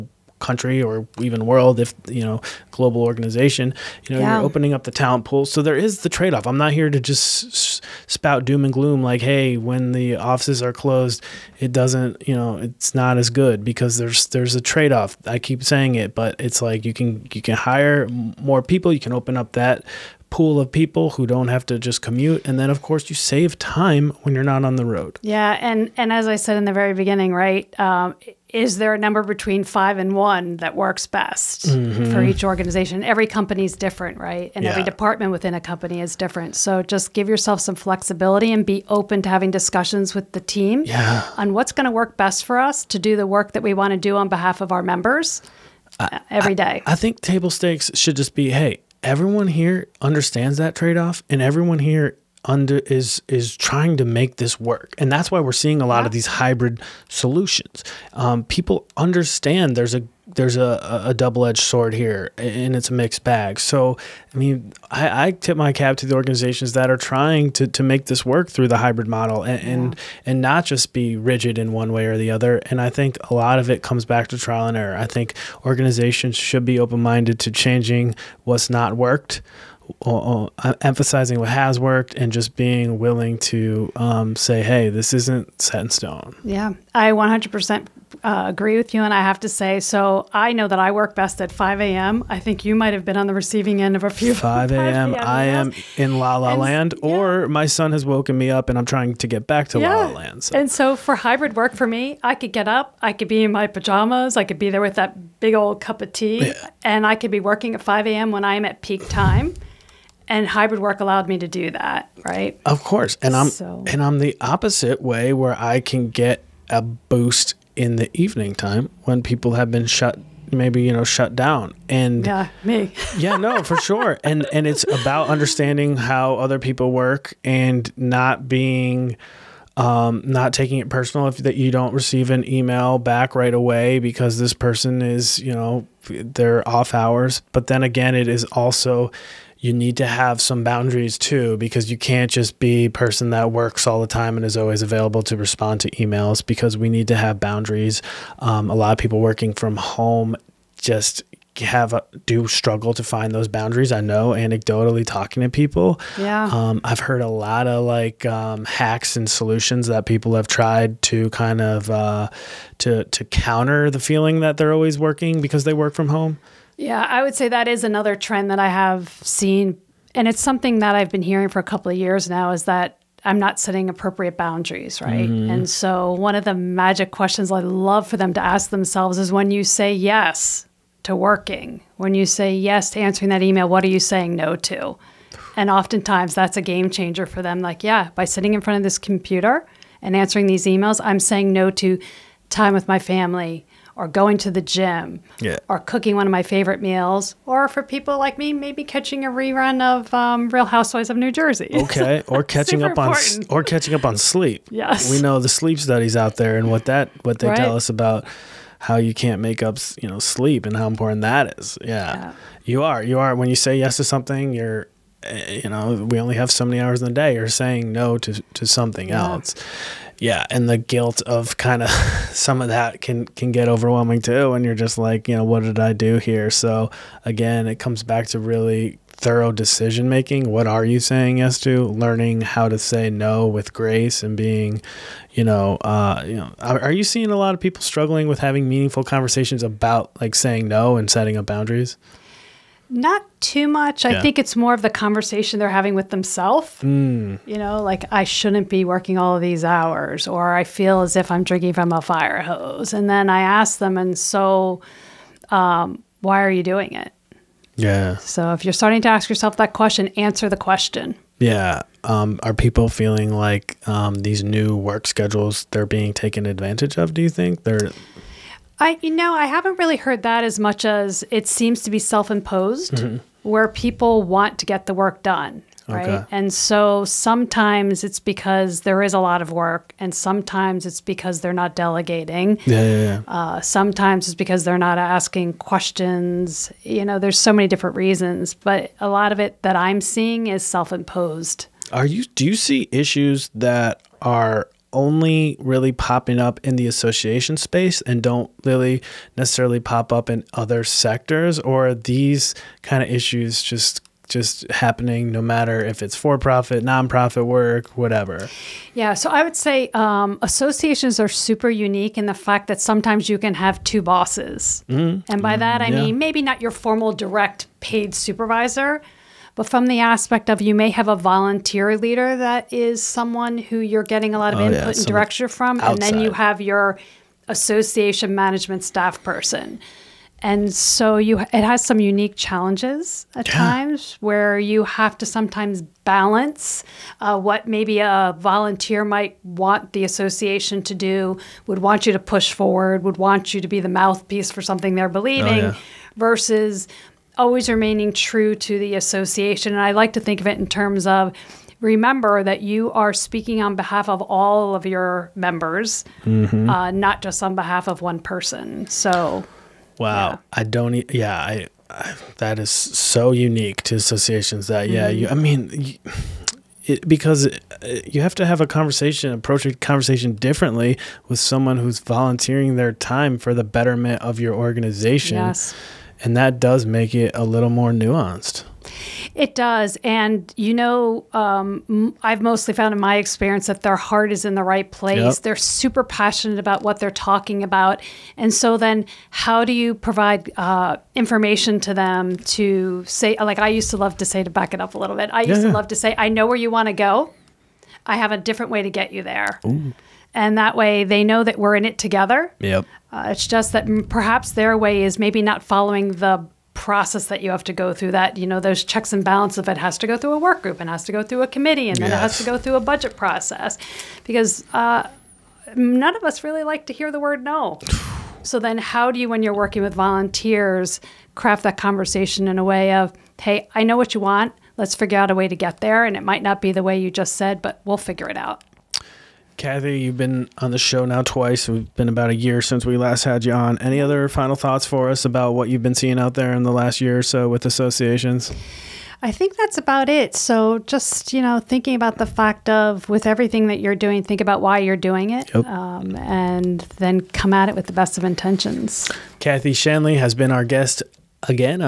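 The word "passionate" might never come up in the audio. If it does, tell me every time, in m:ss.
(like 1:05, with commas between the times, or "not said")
6:26.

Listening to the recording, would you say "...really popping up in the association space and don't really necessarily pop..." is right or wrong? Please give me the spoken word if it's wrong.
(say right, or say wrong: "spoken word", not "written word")
right.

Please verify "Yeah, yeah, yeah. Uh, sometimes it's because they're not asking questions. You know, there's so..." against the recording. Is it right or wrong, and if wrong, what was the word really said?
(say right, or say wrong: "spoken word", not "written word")
right.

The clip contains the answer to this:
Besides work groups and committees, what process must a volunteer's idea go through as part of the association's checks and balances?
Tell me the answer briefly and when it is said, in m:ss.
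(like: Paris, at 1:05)
budget process, at 6:52.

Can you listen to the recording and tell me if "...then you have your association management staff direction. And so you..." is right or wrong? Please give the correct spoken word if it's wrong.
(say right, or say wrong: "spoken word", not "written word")
wrong: "person", not "direction".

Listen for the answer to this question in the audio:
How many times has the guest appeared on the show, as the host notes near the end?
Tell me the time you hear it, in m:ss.
7:11.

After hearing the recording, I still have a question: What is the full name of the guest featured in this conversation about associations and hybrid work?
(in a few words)
Kathy Shanley.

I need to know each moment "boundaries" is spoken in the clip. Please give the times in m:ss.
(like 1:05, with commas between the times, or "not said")
2:20, 2:27, 2:33, 2:54, 4:01.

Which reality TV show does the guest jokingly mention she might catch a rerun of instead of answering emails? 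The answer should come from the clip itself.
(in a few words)
Real Housewives of New Jersey.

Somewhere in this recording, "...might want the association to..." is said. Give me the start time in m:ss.
5:39.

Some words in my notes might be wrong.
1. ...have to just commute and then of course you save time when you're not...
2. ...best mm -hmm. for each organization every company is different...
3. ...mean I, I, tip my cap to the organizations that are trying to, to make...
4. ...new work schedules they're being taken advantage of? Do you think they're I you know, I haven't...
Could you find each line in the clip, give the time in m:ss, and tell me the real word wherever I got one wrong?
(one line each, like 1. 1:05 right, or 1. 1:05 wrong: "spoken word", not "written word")
1. 0:21 right
2. 0:31 right
3. 1:04 right
4. 4:24 right.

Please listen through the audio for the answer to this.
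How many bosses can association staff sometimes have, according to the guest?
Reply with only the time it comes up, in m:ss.
5:13.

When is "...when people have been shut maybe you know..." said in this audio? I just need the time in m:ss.
1:59.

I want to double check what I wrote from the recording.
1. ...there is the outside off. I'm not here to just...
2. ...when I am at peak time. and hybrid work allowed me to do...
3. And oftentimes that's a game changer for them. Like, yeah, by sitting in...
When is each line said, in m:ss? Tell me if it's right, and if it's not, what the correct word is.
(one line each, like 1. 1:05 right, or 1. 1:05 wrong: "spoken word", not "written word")
1. 0:05 wrong: "trade", not "outside"
2. 1:48 right
3. 3:05 right.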